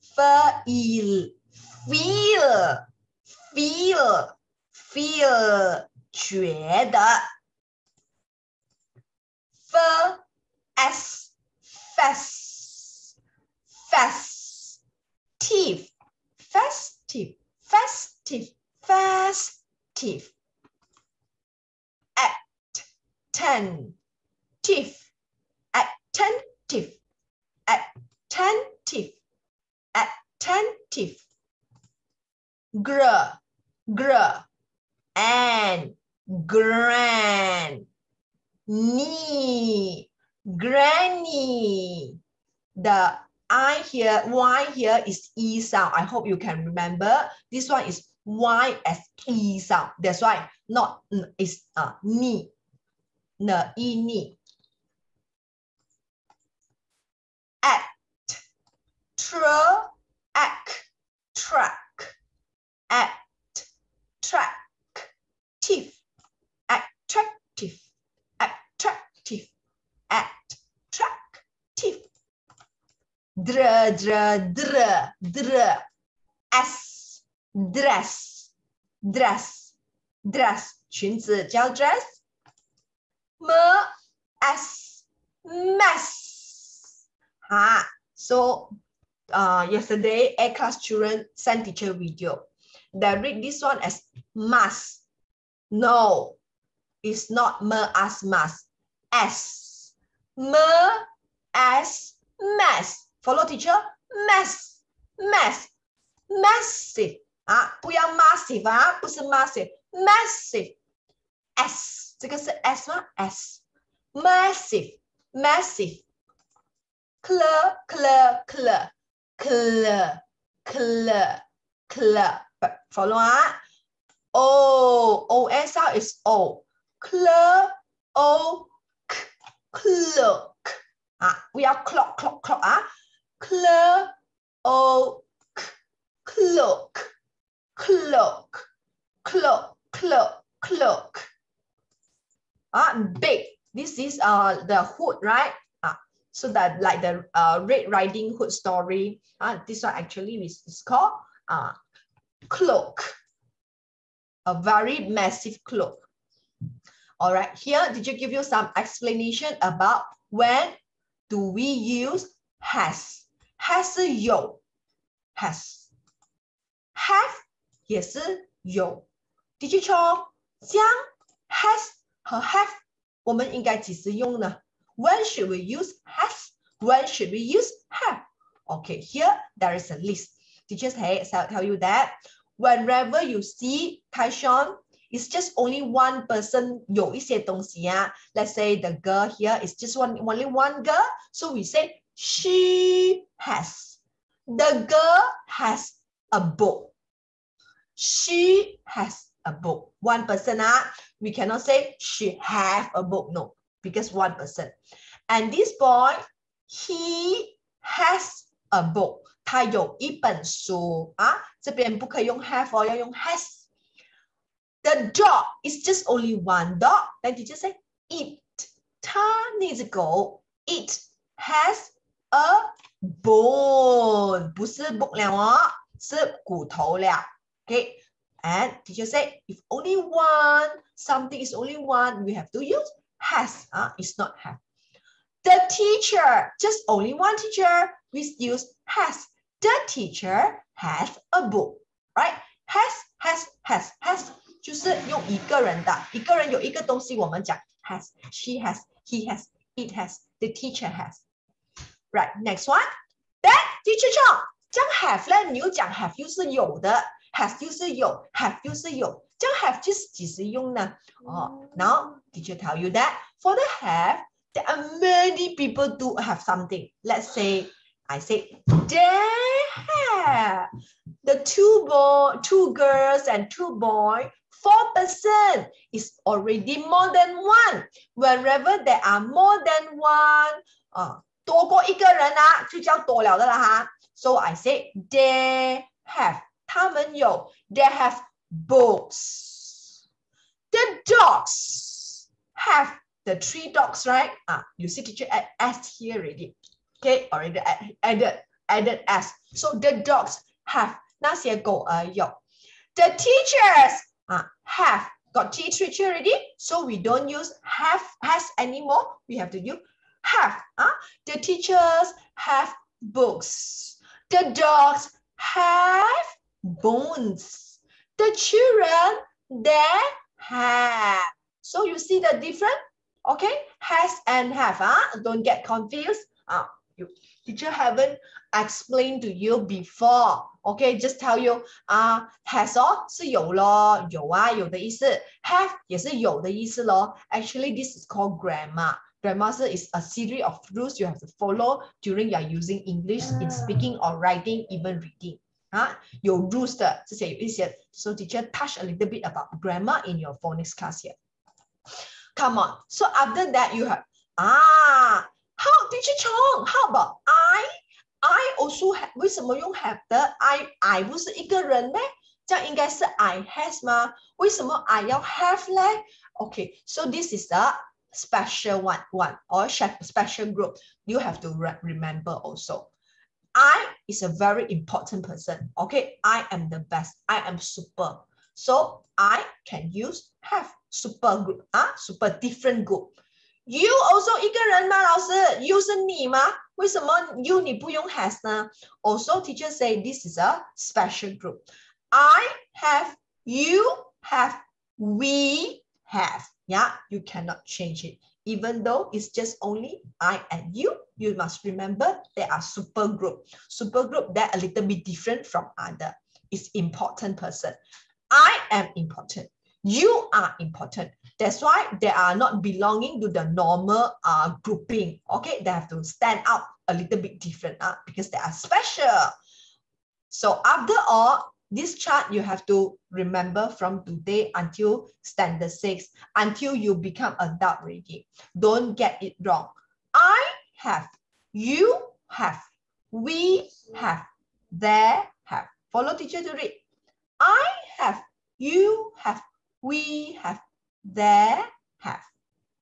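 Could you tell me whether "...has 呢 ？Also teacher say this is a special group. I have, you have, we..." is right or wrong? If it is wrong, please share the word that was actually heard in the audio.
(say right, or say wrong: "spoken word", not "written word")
right.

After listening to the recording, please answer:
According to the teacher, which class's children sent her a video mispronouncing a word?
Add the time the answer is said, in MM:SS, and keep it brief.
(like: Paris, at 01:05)
A class, at 01:30.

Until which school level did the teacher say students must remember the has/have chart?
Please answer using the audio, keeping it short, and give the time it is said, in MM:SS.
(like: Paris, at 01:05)
standard six, at 07:05.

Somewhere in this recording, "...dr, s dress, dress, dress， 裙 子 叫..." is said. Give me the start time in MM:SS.
01:15.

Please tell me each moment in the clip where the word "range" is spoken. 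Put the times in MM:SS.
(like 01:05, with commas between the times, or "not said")
not said.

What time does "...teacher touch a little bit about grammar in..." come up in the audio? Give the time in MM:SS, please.
05:48.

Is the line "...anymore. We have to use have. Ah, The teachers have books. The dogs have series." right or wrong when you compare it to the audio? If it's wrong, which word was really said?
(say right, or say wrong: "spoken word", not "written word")
wrong: "bones", not "series".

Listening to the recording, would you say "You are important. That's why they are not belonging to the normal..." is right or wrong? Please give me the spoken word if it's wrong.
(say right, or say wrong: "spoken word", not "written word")
right.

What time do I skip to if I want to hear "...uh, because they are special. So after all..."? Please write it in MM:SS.
06:57.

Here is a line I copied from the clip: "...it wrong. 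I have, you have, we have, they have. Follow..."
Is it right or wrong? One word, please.
right.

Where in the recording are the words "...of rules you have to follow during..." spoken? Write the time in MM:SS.
05:40.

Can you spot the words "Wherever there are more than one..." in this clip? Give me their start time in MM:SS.
04:38.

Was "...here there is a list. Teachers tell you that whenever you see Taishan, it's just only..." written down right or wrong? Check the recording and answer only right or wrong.
right.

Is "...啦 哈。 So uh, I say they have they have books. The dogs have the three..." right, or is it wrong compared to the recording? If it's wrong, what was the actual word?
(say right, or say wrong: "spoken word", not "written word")
right.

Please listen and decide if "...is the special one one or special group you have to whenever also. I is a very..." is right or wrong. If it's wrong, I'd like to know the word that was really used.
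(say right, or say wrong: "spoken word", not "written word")
wrong: "remember", not "whenever".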